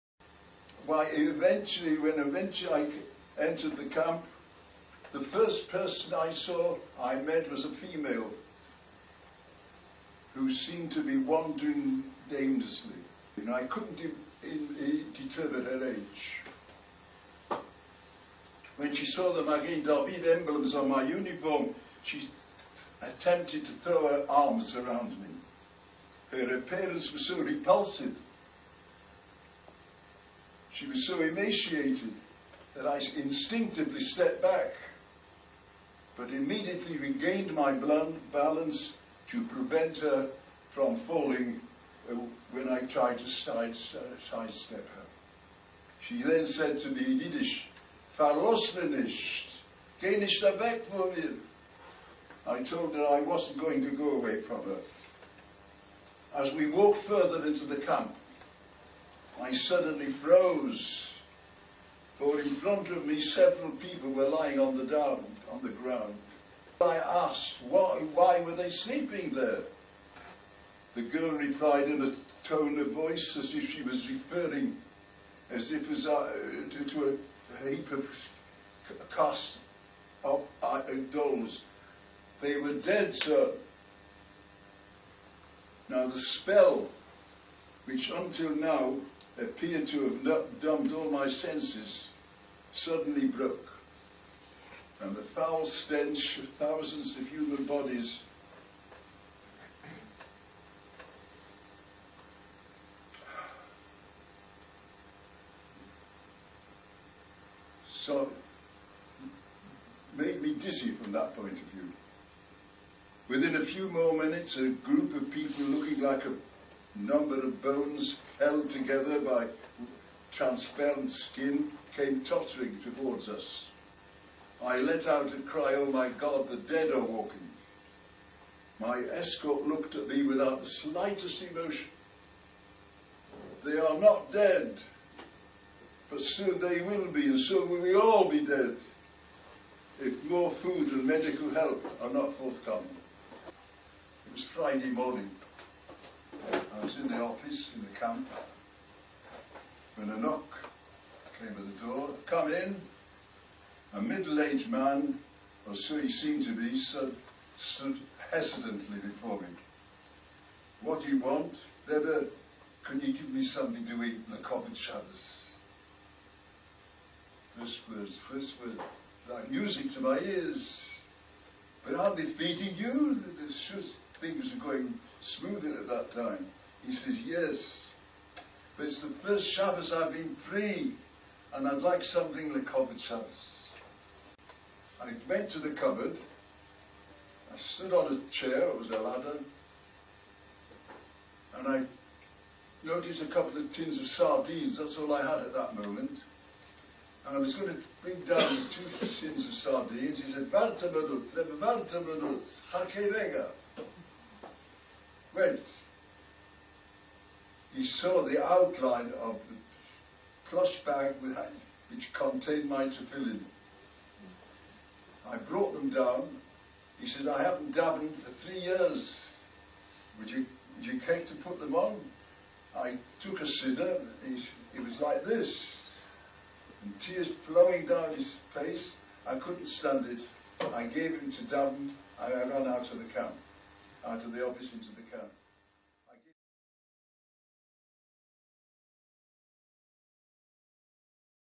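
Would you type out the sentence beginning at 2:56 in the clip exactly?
He says, Yes, but it's the first Shabbos I've been free, and I'd like something the covered Shabbos.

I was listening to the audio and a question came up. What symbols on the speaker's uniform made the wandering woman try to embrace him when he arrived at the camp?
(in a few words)
Magen David.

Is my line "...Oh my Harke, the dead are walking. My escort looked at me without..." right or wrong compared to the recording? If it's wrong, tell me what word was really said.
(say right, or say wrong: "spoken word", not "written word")
wrong: "God", not "Harke".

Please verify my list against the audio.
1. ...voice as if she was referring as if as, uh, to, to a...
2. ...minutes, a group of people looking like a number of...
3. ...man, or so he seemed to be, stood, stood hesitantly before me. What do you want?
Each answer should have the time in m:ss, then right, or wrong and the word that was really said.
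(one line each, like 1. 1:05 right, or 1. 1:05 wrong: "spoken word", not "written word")
1. 1:12 right
2. 1:54 right
3. 2:34 right.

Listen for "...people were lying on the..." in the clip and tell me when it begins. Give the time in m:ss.
1:03.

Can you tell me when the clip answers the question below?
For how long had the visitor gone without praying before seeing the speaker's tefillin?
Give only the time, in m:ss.
3:38.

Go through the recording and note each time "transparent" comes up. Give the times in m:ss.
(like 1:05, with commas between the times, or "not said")
2:00.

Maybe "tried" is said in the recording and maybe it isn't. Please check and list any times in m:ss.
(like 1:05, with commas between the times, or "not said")
0:42.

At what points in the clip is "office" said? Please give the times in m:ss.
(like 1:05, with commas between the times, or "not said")
2:27, 3:54.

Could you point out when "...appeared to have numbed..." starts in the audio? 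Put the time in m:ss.
1:29.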